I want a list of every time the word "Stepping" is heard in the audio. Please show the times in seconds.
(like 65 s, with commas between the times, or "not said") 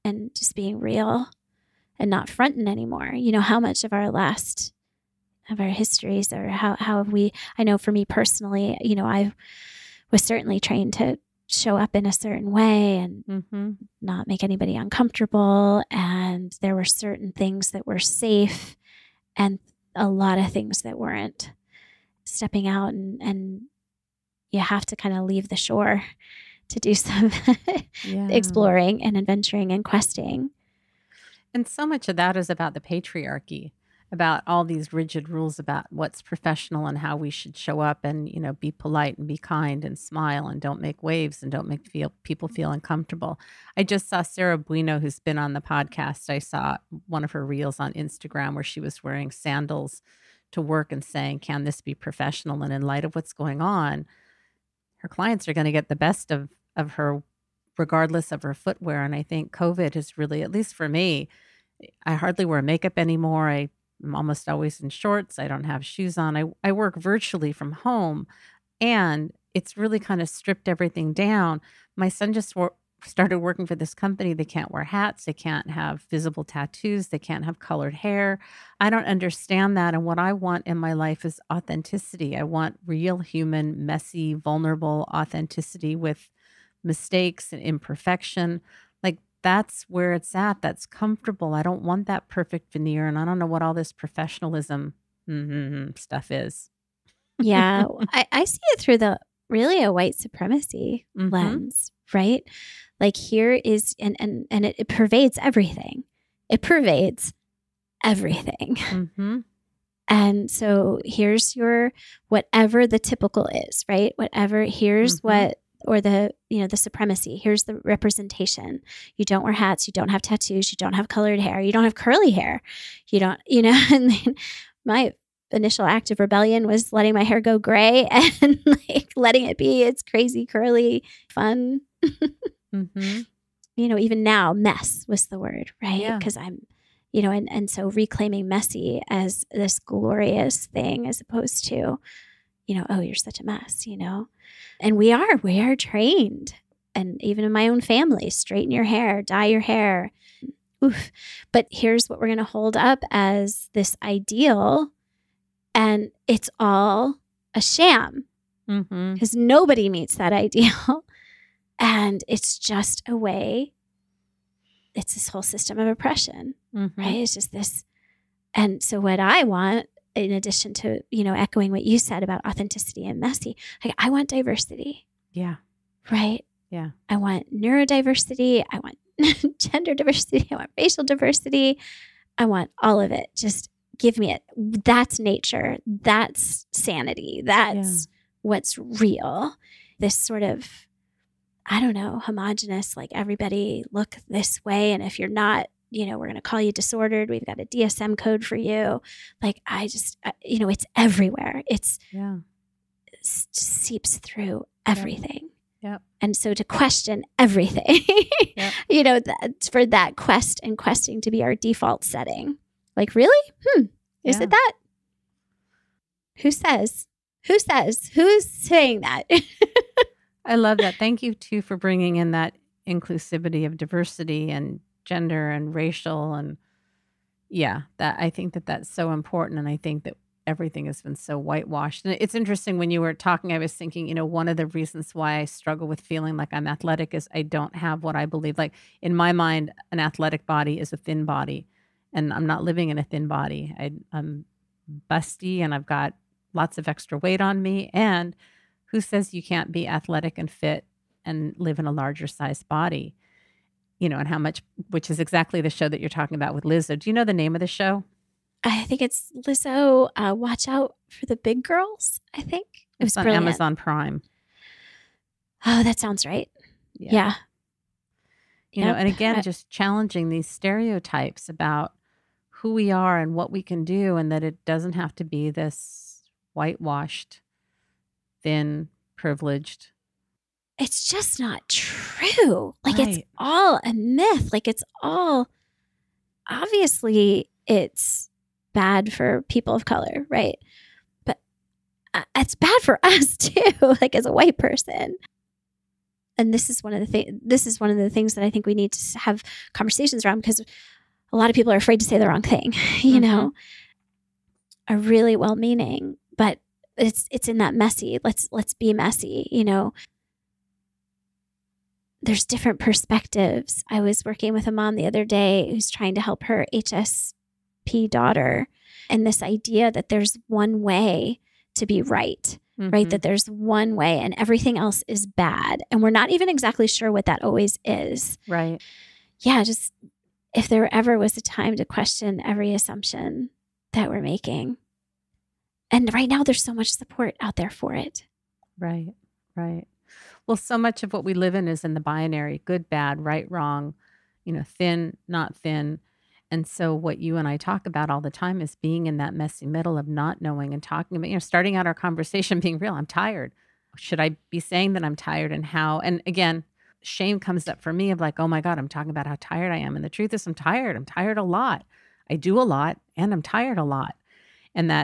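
22 s.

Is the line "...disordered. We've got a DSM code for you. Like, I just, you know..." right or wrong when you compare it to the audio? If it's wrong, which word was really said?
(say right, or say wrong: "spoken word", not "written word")
right.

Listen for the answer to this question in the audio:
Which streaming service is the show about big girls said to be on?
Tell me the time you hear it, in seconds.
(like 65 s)
263 s.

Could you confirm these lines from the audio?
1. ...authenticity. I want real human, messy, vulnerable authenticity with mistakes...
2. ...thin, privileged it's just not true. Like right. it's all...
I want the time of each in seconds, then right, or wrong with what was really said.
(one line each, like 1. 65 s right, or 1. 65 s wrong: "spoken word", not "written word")
1. 81 s right
2. 278 s right.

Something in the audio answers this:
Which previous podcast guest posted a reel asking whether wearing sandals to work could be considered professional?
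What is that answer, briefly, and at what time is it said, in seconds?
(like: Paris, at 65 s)
Sarah Bueno, at 44 s.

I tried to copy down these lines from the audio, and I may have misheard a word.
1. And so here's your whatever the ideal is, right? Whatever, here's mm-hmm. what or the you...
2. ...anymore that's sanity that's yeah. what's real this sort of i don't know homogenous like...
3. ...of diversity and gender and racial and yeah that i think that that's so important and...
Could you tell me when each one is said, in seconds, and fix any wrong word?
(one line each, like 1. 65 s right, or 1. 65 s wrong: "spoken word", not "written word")
1. 110 s wrong: "typical", not "ideal"
2. 185 s wrong: "nature", not "anymore"
3. 223 s right.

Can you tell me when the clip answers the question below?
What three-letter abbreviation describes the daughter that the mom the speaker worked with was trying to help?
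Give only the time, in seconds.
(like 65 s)
316 s.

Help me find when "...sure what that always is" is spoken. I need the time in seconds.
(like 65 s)
326 s.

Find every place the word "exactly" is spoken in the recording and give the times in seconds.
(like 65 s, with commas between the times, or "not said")
255 s, 326 s.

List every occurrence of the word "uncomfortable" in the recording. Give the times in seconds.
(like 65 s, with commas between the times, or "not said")
14 s, 42 s.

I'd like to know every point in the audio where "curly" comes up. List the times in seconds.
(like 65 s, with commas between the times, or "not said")
121 s, 130 s.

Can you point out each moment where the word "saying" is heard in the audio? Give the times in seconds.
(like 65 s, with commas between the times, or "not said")
51 s, 218 s, 354 s.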